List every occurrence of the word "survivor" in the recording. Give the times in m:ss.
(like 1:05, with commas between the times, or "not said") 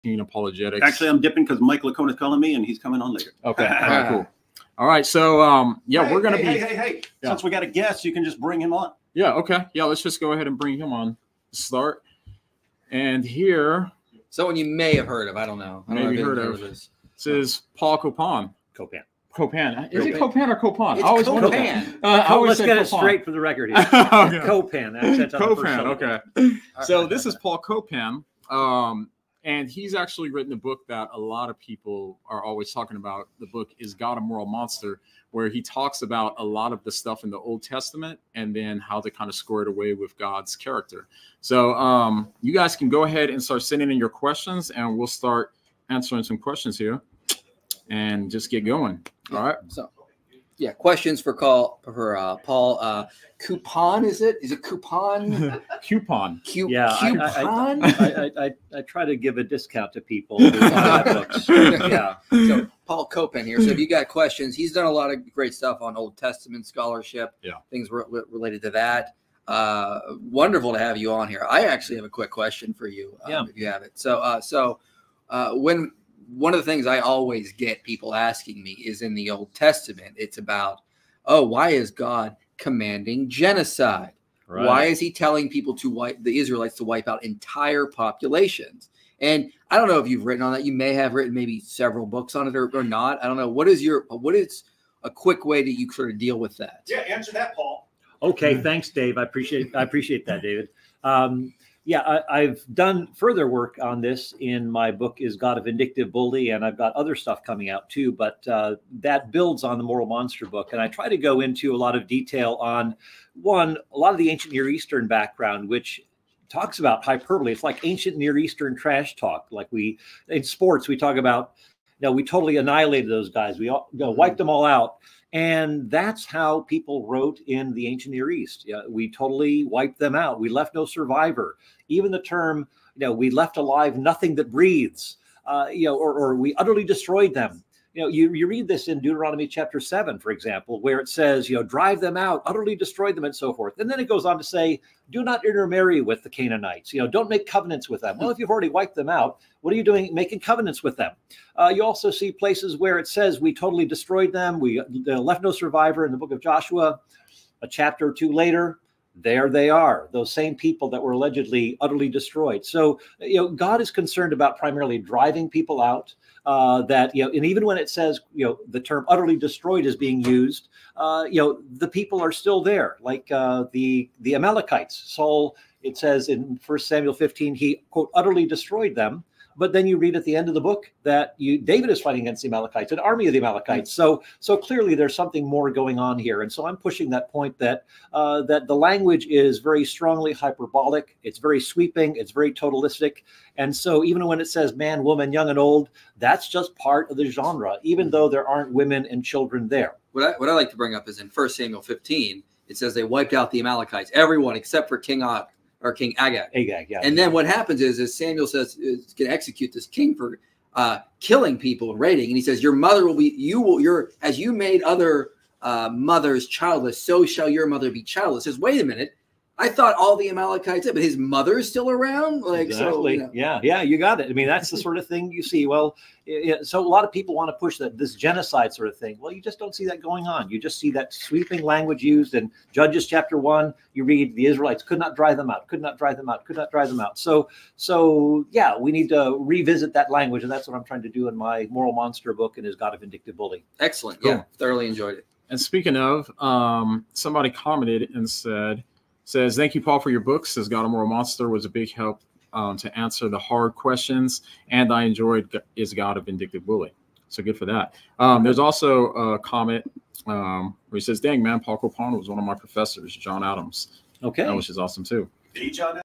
2:10, 2:35.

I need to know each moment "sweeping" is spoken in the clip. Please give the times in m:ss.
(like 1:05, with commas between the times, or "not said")
3:11, 3:51.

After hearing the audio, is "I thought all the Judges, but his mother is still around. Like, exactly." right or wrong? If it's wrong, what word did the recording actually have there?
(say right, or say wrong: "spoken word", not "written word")
wrong: "Amalekites", not "Judges".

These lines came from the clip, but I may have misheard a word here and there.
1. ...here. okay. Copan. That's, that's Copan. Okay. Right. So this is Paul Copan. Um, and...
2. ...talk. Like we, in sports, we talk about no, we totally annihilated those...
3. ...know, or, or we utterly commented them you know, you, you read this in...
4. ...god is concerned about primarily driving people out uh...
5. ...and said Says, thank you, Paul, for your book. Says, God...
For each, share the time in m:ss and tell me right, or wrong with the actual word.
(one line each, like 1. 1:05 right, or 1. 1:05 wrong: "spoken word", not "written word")
1. 0:23 right
2. 1:59 right
3. 2:15 wrong: "destroyed", not "commented"
4. 2:43 right
5. 4:08 right.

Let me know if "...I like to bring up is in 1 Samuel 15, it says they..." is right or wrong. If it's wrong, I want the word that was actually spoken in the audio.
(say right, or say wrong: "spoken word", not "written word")
right.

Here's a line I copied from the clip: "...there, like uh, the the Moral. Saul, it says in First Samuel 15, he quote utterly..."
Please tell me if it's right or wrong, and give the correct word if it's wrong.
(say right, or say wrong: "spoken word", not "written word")
wrong: "Amalekites", not "Moral".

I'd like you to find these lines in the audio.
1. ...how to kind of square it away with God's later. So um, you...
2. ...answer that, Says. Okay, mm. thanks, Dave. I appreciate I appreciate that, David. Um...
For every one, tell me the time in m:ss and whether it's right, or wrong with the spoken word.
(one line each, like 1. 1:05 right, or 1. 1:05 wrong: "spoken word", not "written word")
1. 0:38 wrong: "character", not "later"
2. 1:36 wrong: "Paul", not "Says".